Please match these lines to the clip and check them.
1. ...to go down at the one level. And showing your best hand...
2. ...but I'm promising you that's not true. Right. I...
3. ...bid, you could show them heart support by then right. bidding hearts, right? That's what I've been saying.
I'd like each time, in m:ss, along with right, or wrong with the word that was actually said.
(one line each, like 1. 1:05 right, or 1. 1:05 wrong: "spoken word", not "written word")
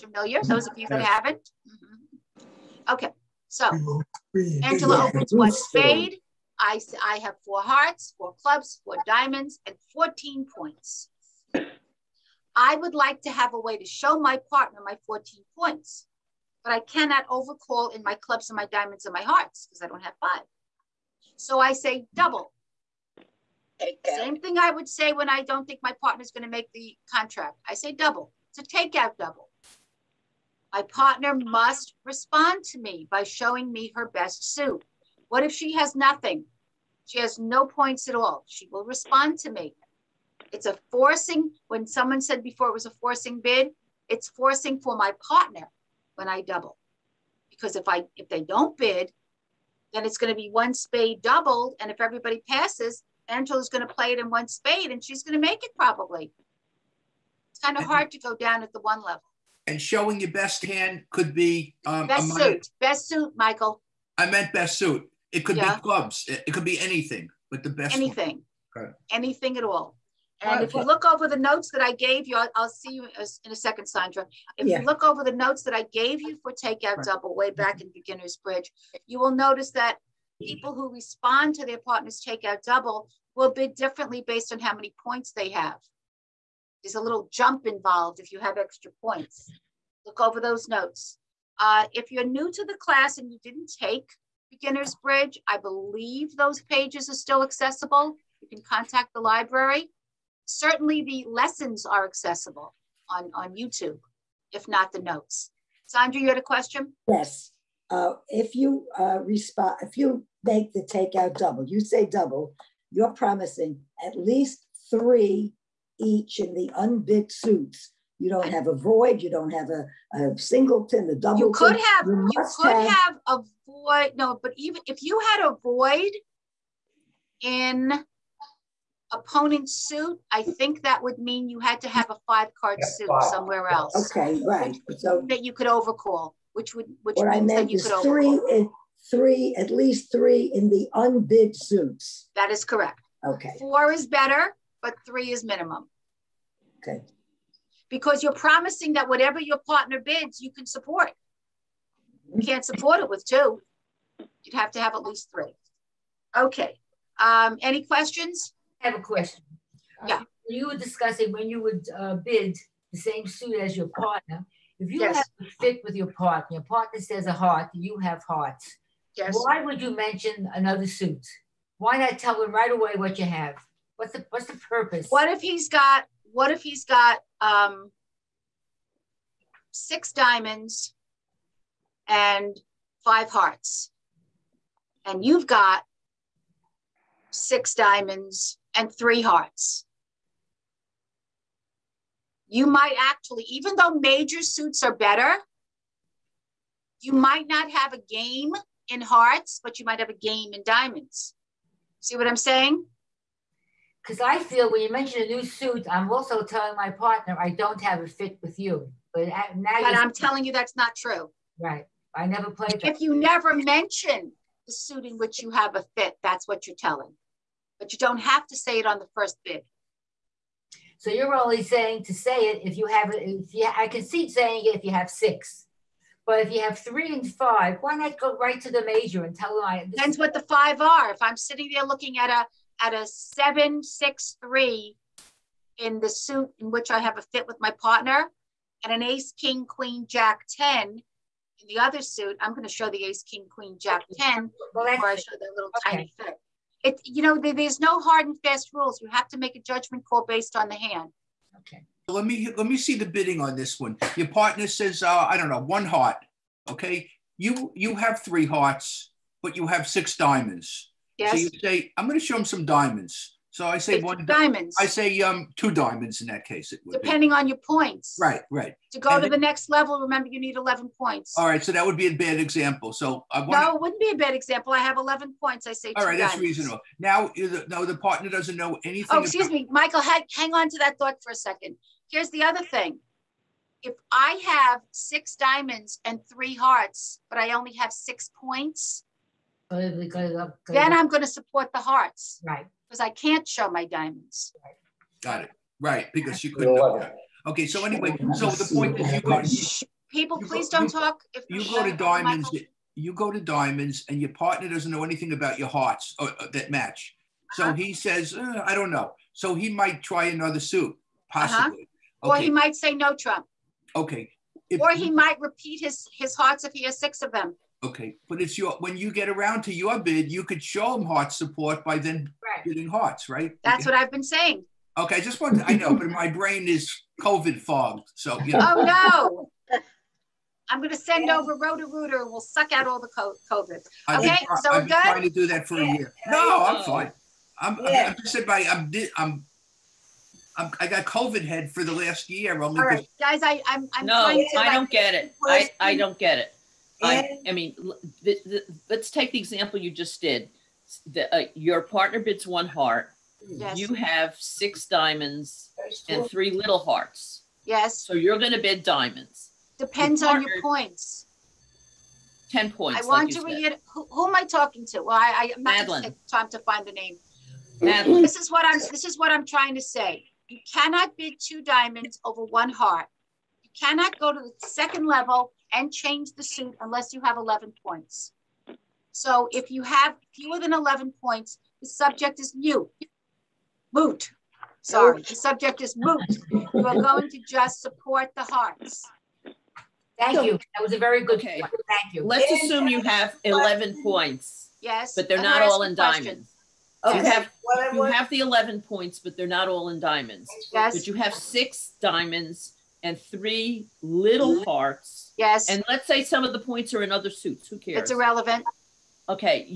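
1. 0:58 right
2. 3:29 wrong: "telling", not "promising"
3. 5:19 right.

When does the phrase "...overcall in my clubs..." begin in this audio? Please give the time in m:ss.
0:17.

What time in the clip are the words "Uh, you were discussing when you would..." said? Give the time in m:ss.
2:40.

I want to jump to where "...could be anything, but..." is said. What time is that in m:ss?
1:06.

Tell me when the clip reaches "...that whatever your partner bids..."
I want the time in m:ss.
2:28.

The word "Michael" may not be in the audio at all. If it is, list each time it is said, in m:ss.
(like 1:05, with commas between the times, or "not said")
1:03, 4:39.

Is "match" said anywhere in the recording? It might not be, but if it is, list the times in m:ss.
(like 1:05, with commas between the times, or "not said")
5:06.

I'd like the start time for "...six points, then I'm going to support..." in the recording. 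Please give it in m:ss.
4:47.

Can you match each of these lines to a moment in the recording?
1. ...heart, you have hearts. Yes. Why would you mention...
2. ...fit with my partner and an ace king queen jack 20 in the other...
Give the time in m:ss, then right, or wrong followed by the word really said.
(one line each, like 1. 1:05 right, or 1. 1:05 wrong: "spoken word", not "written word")
1. 2:47 right
2. 3:57 wrong: "10", not "20".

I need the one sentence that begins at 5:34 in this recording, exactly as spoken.
Okay, been, so I've we're good.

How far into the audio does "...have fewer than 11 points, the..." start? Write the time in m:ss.
6:19.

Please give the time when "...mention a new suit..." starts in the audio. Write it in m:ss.
3:24.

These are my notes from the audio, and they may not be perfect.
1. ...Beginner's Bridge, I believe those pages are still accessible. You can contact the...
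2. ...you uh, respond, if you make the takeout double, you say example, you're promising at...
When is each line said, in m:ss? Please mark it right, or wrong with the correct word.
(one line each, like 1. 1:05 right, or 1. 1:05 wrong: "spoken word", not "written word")
1. 1:34 right
2. 1:48 wrong: "double", not "example".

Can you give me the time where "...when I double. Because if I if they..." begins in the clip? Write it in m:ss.
0:46.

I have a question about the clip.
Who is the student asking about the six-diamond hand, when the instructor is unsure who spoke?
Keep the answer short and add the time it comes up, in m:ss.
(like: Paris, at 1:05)
Madeline, at 6:07.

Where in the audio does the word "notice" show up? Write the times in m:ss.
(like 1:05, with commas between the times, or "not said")
1:19.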